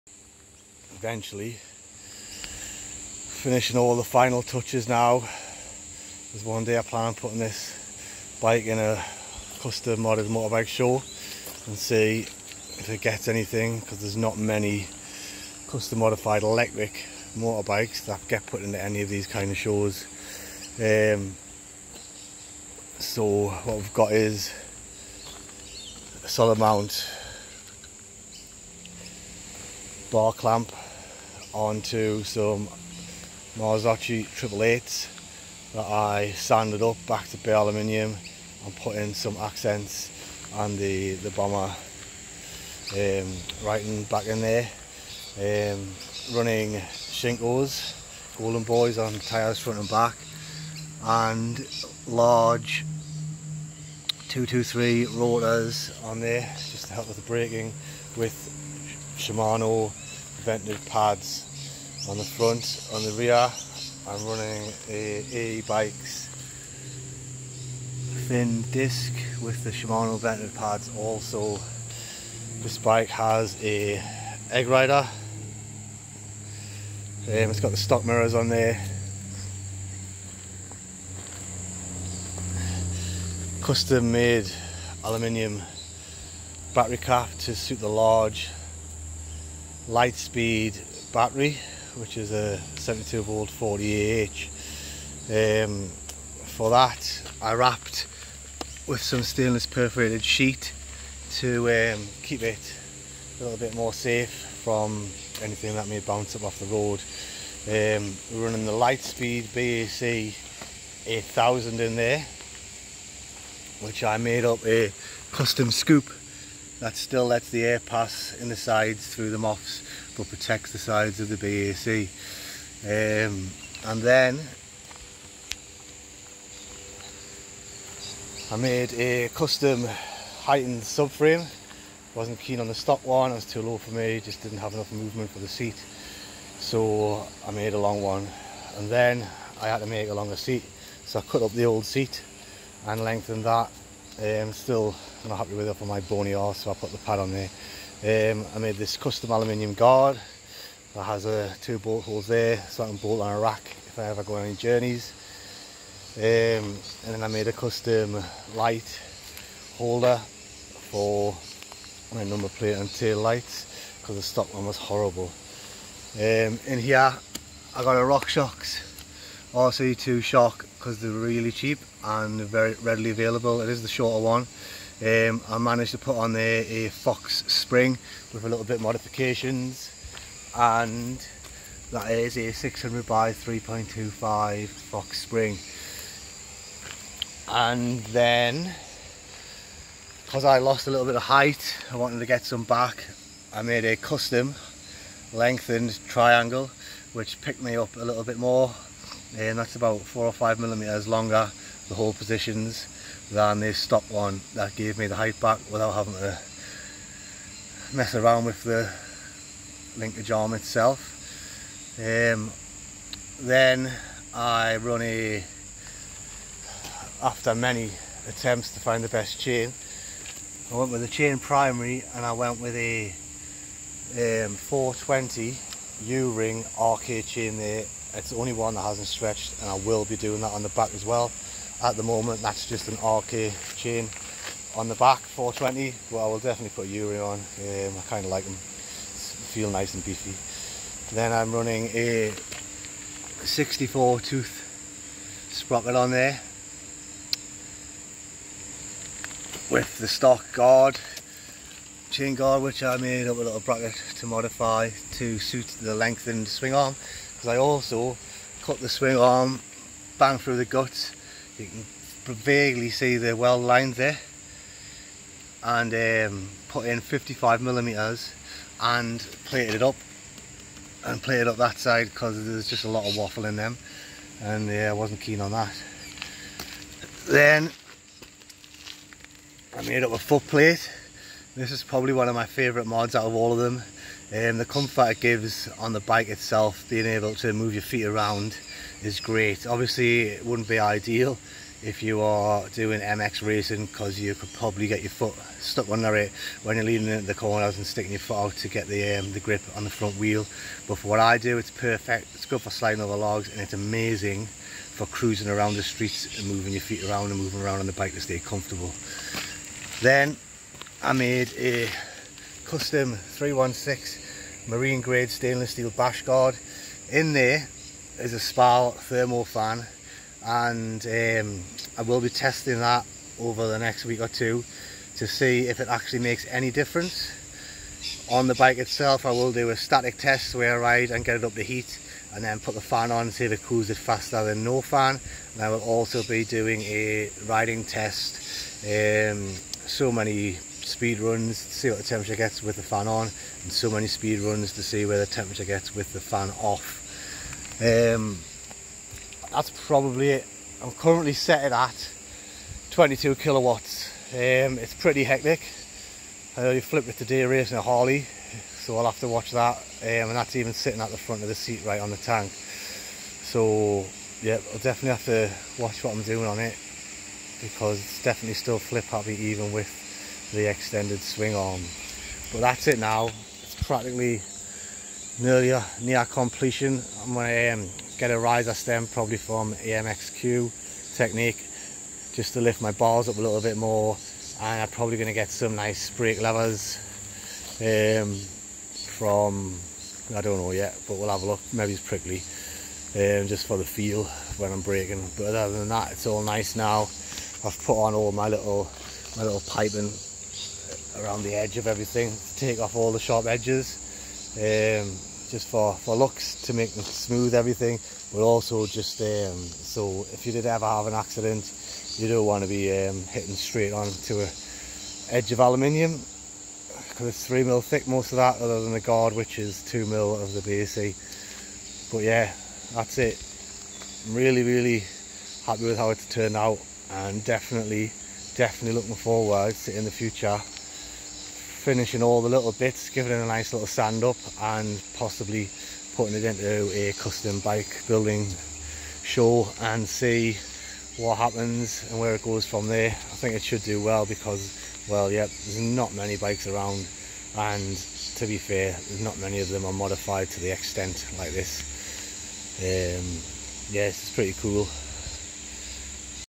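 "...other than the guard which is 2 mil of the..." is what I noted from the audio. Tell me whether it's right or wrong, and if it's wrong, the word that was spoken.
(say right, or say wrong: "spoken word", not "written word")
right.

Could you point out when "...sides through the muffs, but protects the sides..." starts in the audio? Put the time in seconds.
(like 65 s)
118 s.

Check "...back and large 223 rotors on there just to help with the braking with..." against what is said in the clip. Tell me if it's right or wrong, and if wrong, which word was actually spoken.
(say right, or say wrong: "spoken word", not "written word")
right.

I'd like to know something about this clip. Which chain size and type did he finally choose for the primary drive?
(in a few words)
420 U-ring RK.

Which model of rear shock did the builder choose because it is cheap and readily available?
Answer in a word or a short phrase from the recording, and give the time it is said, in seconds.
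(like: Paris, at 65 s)
RockShox RC2, at 167 s.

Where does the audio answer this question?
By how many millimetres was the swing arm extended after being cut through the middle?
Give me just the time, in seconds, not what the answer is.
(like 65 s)
266 s.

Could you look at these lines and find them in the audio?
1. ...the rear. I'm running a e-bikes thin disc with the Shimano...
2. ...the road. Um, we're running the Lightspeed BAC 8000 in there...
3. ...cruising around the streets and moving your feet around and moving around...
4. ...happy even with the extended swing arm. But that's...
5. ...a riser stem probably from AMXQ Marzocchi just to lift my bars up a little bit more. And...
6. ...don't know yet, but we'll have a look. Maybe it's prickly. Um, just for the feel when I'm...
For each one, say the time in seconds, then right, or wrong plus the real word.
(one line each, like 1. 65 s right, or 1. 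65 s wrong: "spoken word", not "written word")
1. 63 s right
2. 106 s right
3. 305 s right
4. 369 s right
5. 378 s wrong: "Technique", not "Marzocchi"
6. 390 s right.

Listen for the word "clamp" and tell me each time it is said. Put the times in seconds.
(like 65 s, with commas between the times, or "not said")
30 s.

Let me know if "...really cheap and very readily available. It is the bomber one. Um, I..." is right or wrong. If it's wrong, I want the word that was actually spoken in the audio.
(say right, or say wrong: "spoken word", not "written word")
wrong: "shorter", not "bomber".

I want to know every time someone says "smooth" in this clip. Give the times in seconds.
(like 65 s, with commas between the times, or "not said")
407 s.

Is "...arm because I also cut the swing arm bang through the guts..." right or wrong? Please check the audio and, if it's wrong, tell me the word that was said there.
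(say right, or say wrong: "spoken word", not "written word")
right.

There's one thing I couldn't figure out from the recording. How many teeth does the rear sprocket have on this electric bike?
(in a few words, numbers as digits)
64.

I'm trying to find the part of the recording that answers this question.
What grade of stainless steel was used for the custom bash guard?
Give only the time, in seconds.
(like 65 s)
313 s.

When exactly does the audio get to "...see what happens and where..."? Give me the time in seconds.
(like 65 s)
440 s.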